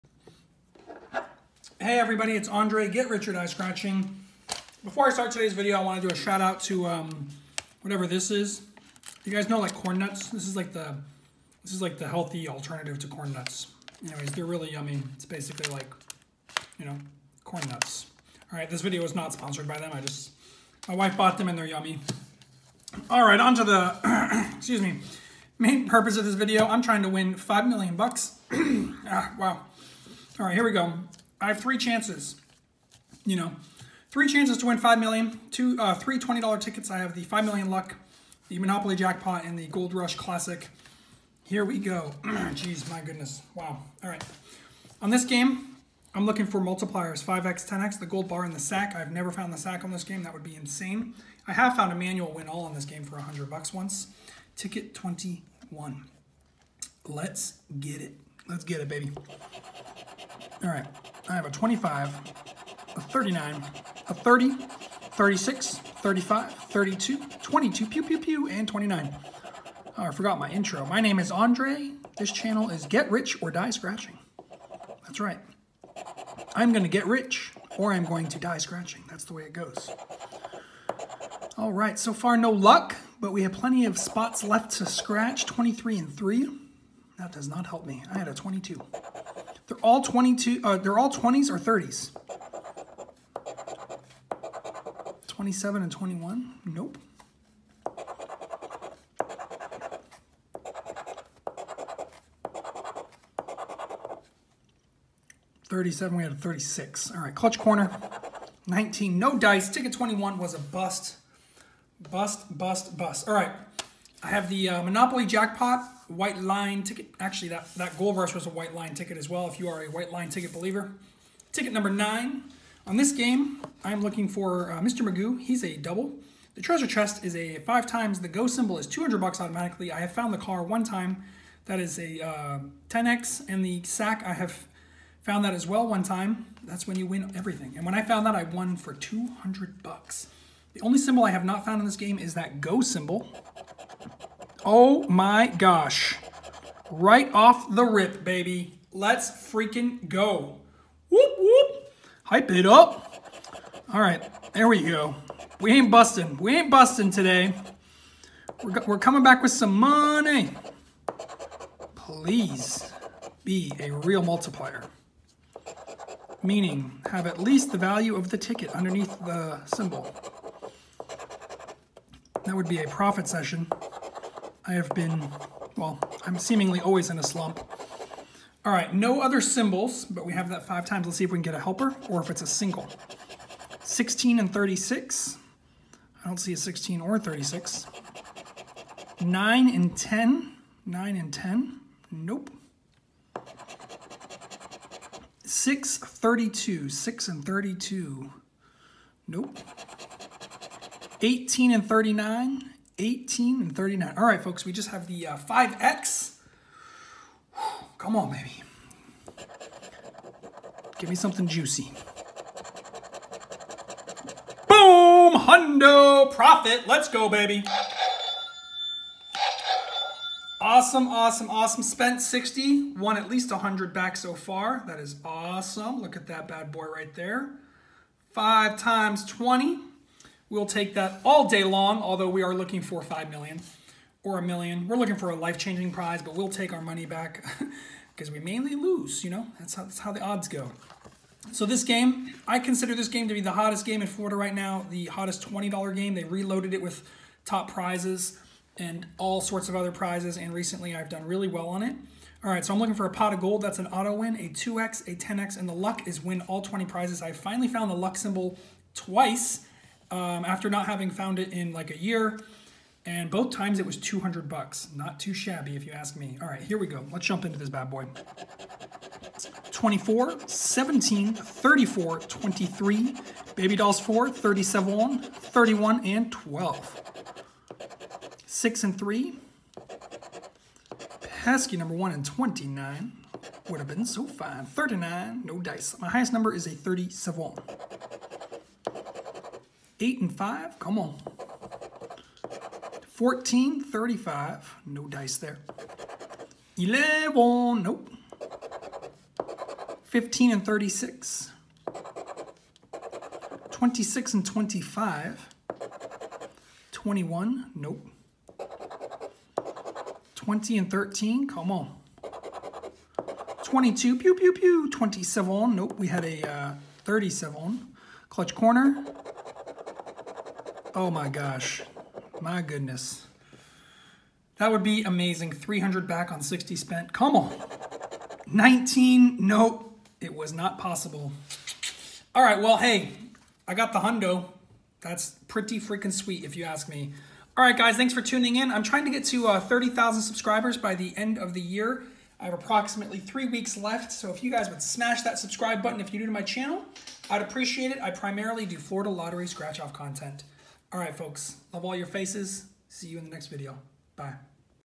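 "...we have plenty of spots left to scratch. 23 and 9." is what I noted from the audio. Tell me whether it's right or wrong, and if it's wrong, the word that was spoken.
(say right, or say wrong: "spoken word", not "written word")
wrong: "3", not "9".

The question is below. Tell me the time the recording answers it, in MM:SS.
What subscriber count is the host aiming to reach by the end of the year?
05:39.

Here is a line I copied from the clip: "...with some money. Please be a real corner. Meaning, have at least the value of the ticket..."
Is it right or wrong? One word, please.
wrong.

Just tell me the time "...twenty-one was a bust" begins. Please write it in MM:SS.
01:49.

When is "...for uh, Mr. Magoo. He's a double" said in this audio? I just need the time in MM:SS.
02:04.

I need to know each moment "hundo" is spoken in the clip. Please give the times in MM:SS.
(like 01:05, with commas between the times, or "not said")
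03:35, 05:33.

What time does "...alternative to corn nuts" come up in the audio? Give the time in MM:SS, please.
00:12.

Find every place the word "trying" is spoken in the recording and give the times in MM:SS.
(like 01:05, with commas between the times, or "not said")
00:26, 05:38.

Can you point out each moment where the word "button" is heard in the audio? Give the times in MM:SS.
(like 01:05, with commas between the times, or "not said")
05:45.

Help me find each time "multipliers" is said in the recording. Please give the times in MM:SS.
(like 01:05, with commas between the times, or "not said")
00:46, 02:44.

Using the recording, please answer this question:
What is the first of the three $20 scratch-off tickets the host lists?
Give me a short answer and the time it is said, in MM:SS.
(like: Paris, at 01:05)
Five Million Luck, at 00:37.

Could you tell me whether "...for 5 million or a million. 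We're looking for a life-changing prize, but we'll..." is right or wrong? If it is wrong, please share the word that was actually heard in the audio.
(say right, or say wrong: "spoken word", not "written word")
right.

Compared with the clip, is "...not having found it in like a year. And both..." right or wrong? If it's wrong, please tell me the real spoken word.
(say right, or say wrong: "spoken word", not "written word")
right.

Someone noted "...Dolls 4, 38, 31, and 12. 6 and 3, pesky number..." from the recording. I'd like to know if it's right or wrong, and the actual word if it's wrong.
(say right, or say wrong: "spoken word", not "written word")
wrong: "37", not "38".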